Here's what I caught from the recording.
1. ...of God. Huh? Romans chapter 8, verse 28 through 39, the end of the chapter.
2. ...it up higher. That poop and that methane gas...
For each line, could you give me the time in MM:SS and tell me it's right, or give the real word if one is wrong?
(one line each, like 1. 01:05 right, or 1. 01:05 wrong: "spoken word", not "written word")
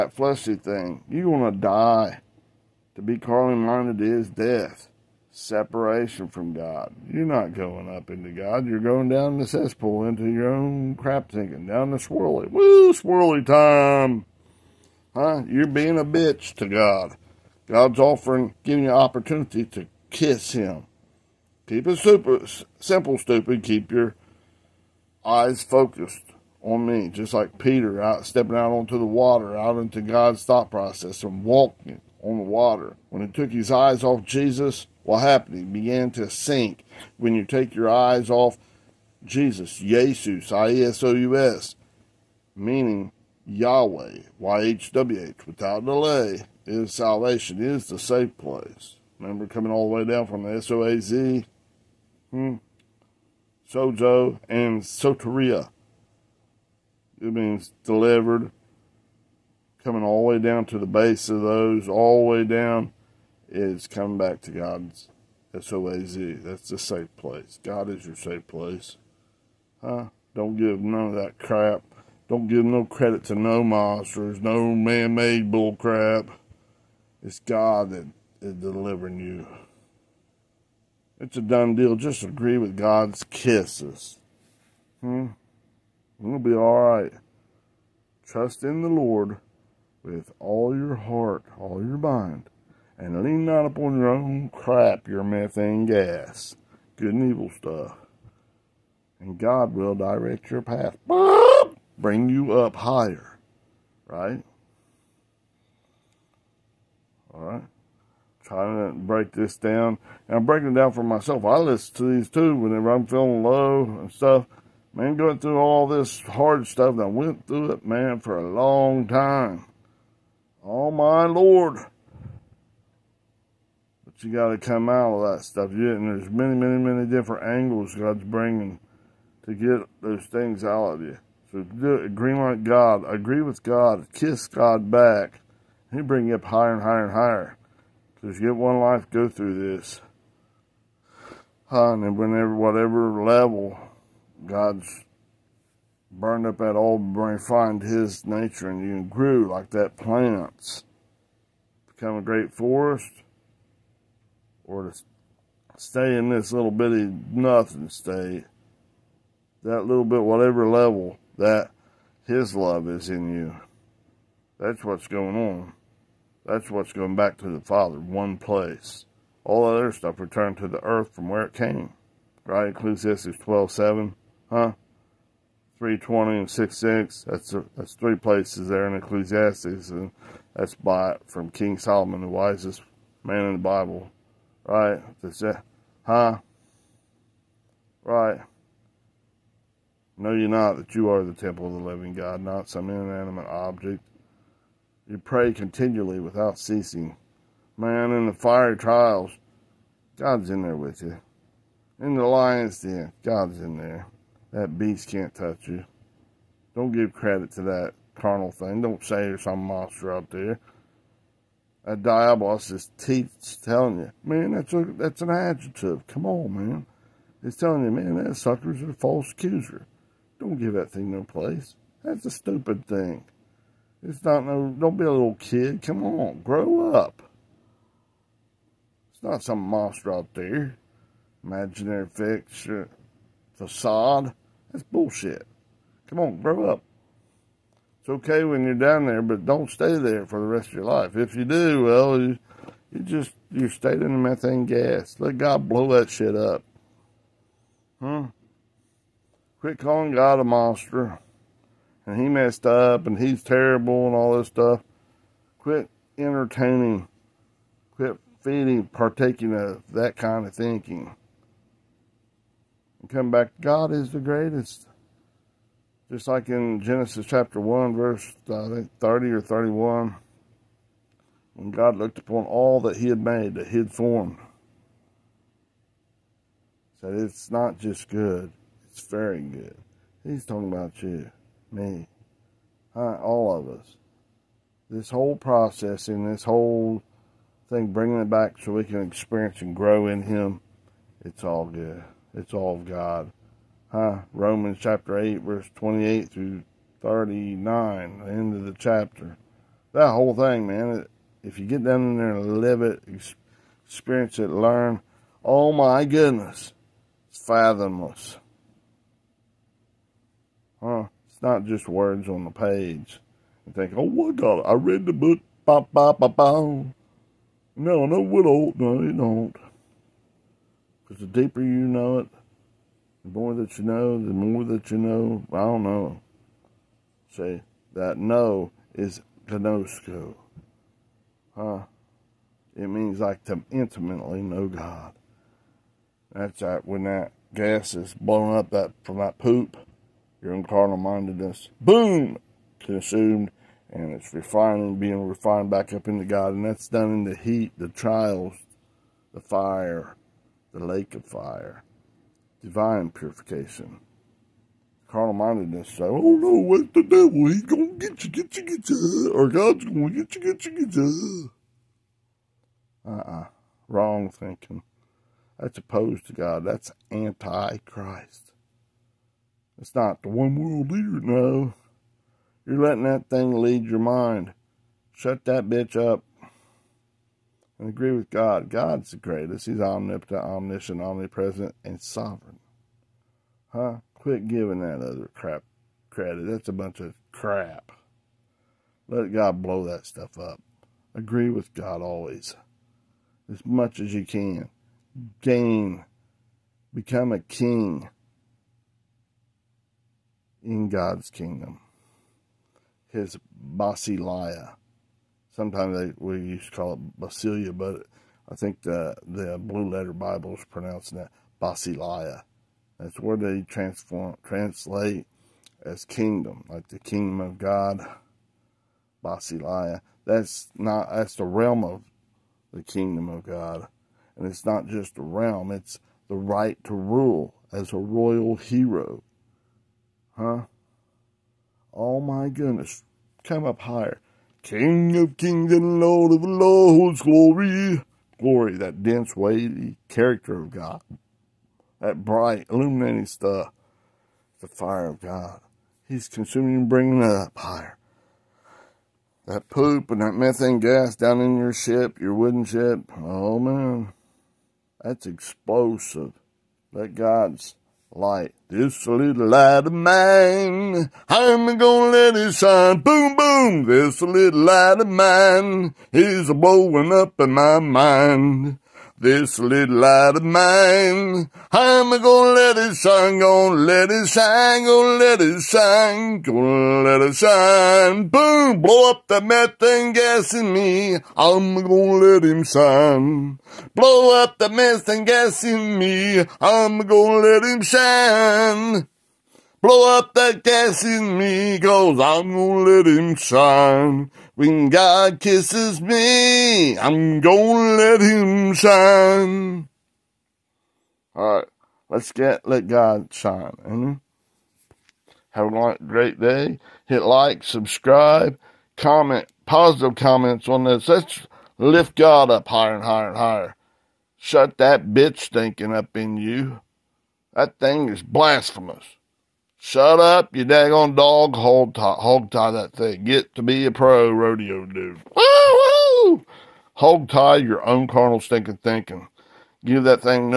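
1. 04:52 right
2. 07:27 right.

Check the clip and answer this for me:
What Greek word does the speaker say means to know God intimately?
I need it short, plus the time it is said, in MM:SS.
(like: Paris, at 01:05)
gnosko, at 05:29.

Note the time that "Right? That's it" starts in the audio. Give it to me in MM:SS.
03:04.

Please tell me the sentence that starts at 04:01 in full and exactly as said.
If you do, well, you, you just, you're staying in the methane gas.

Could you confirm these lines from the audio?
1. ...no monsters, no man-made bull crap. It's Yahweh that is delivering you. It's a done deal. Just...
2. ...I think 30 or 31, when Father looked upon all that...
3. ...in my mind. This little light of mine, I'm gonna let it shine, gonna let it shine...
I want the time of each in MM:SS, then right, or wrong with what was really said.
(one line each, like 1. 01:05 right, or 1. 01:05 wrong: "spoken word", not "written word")
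1. 01:13 wrong: "God", not "Yahweh"
2. 04:28 wrong: "God", not "Father"
3. 07:47 right.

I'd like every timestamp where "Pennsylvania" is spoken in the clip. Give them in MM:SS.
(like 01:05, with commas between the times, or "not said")
not said.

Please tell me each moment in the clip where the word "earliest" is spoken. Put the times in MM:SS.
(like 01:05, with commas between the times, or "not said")
not said.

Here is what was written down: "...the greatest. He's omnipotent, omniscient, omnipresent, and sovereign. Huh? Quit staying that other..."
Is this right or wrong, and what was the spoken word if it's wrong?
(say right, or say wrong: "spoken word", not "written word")
wrong: "giving", not "staying".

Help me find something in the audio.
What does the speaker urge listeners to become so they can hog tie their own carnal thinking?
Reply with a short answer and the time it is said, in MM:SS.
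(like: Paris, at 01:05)
pro rodeo dude, at 08:43.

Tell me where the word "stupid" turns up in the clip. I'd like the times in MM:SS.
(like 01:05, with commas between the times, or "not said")
00:23, 03:42.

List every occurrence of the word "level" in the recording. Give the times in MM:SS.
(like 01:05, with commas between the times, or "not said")
02:23, 02:40.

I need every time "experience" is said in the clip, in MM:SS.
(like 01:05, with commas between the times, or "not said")
04:49, 05:03.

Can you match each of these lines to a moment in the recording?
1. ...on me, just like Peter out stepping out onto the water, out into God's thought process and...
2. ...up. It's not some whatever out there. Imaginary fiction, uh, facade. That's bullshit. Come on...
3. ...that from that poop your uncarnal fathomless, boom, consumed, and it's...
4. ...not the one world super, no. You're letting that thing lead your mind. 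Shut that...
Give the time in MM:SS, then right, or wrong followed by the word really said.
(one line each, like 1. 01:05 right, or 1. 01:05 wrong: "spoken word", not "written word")
1. 00:26 right
2. 03:46 wrong: "monster", not "whatever"
3. 05:38 wrong: "mindedness", not "fathomless"
4. 06:09 wrong: "leader", not "super".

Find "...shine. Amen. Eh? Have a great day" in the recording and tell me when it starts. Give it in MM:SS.
08:23.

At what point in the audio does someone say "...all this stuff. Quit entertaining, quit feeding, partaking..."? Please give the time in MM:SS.
04:14.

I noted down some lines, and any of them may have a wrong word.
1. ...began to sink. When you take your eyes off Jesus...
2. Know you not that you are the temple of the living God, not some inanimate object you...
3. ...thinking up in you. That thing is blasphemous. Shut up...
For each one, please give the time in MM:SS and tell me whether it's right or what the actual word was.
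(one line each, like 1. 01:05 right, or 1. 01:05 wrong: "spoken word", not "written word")
1. 00:35 right
2. 03:10 right
3. 08:35 right.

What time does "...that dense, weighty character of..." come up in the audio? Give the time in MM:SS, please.
07:18.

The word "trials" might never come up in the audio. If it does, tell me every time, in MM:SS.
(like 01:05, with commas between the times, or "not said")
03:18, 05:47.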